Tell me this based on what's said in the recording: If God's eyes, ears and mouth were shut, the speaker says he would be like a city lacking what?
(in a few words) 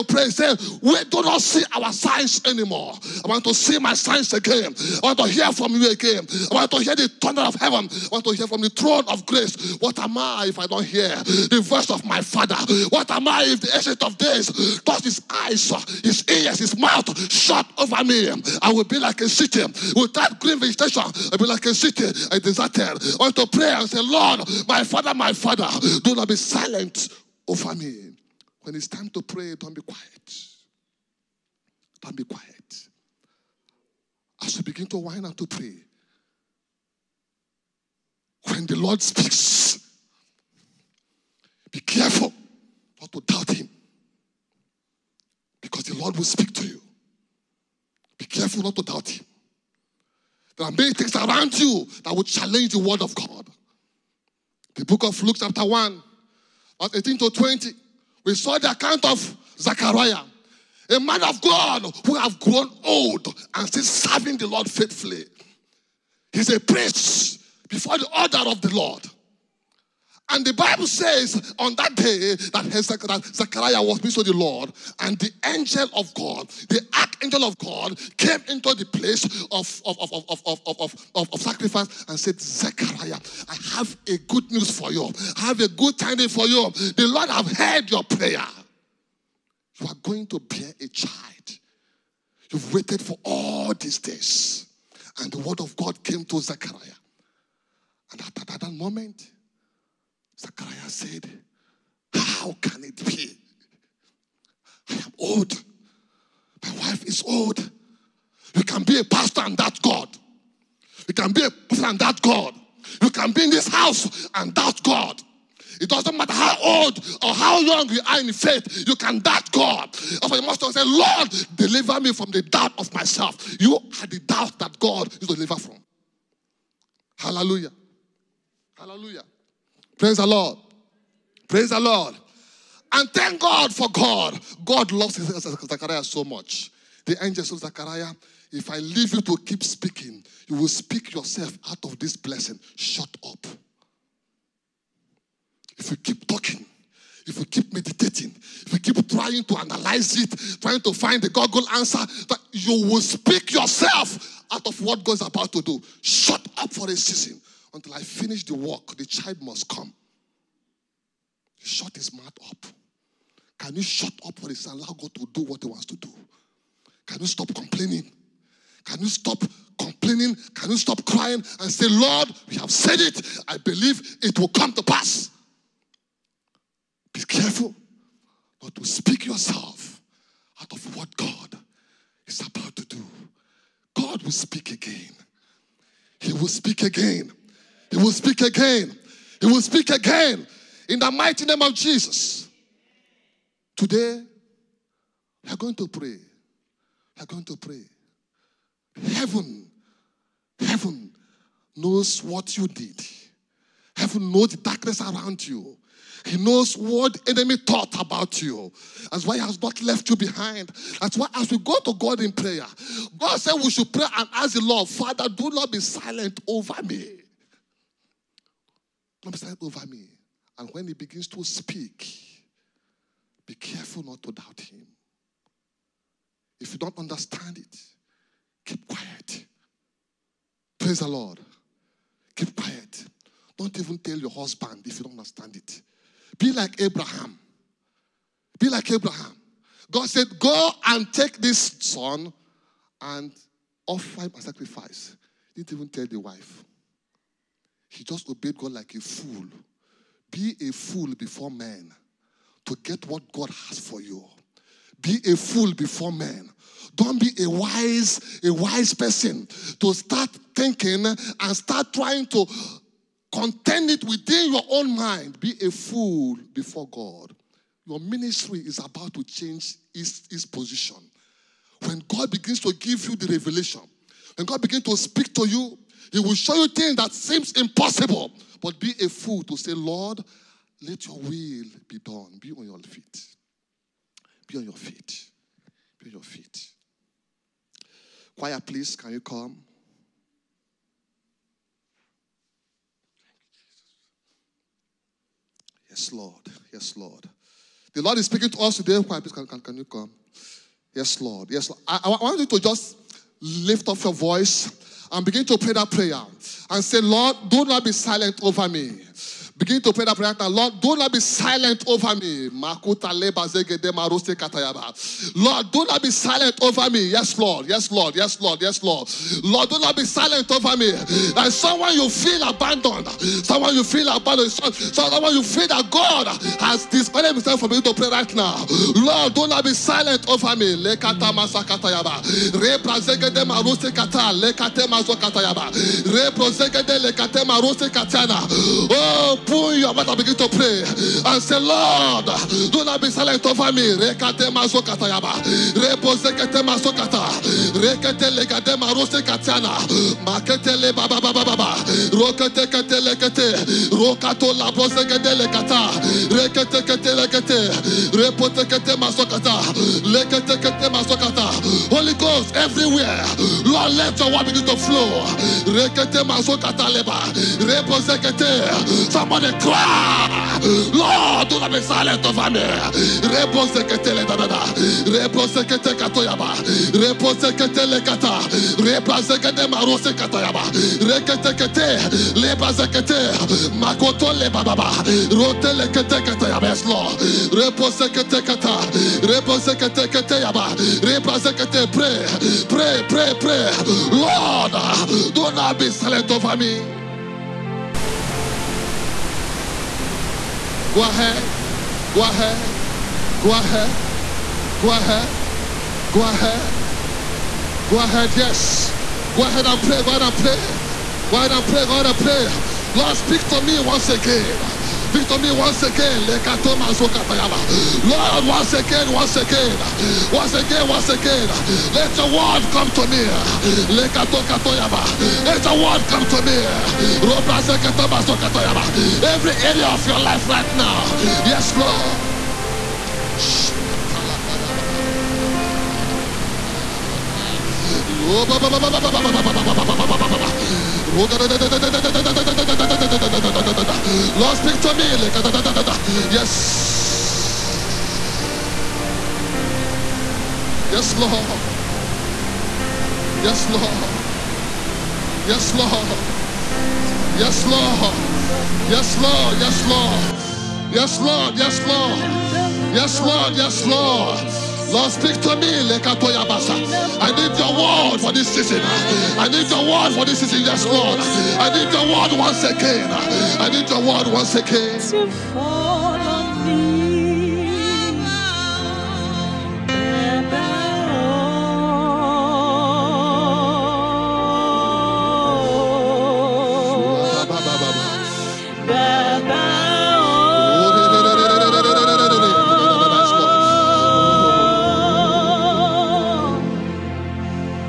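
Green vegetation.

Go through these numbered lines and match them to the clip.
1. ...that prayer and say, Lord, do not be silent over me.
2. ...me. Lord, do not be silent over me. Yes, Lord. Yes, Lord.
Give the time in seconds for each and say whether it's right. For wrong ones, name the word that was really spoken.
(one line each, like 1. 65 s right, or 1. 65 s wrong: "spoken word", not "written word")
1. 305 s right
2. 312 s right.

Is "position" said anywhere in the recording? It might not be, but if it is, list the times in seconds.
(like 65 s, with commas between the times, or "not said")
270 s.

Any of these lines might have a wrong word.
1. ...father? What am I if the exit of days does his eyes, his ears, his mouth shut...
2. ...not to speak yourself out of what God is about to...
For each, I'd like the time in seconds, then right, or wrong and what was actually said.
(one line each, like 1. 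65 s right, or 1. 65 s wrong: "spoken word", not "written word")
1. 12 s right
2. 178 s right.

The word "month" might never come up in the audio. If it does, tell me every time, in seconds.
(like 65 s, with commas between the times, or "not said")
not said.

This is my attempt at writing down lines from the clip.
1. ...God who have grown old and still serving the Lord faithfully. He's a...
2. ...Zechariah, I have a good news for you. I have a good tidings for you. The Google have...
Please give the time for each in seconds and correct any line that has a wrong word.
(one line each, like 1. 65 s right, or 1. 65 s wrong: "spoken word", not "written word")
1. 61 s right
2. 82 s wrong: "Lord", not "Google".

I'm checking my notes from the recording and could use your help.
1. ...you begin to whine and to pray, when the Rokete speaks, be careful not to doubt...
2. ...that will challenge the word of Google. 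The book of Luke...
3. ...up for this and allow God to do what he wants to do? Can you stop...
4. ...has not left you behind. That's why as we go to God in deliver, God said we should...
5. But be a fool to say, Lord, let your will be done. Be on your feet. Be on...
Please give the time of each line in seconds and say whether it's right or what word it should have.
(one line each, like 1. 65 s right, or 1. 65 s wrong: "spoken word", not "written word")
1. 34 s wrong: "Lord", not "Rokete"
2. 52 s wrong: "God", not "Google"
3. 164 s right
4. 209 s wrong: "prayer", not "deliver"
5. 278 s right.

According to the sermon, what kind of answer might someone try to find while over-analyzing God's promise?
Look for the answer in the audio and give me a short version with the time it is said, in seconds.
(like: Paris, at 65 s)
Google answer, at 151 s.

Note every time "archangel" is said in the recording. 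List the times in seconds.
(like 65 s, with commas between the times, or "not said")
76 s.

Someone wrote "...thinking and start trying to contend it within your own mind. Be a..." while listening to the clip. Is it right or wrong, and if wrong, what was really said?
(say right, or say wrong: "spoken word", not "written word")
right.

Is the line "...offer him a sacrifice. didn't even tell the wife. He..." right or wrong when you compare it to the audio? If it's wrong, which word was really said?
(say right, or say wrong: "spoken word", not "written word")
right.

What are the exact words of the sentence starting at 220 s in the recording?
And when he begins to speak, be careful not to doubt him.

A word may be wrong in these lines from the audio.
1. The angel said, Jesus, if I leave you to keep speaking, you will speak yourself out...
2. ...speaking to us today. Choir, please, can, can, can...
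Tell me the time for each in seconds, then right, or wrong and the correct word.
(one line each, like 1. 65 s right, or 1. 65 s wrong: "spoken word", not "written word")
1. 137 s wrong: "Zachariah", not "Jesus"
2. 298 s right.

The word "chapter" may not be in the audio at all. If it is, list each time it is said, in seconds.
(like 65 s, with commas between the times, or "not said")
55 s.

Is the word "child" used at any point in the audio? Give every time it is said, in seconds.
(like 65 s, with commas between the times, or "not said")
90 s, 159 s.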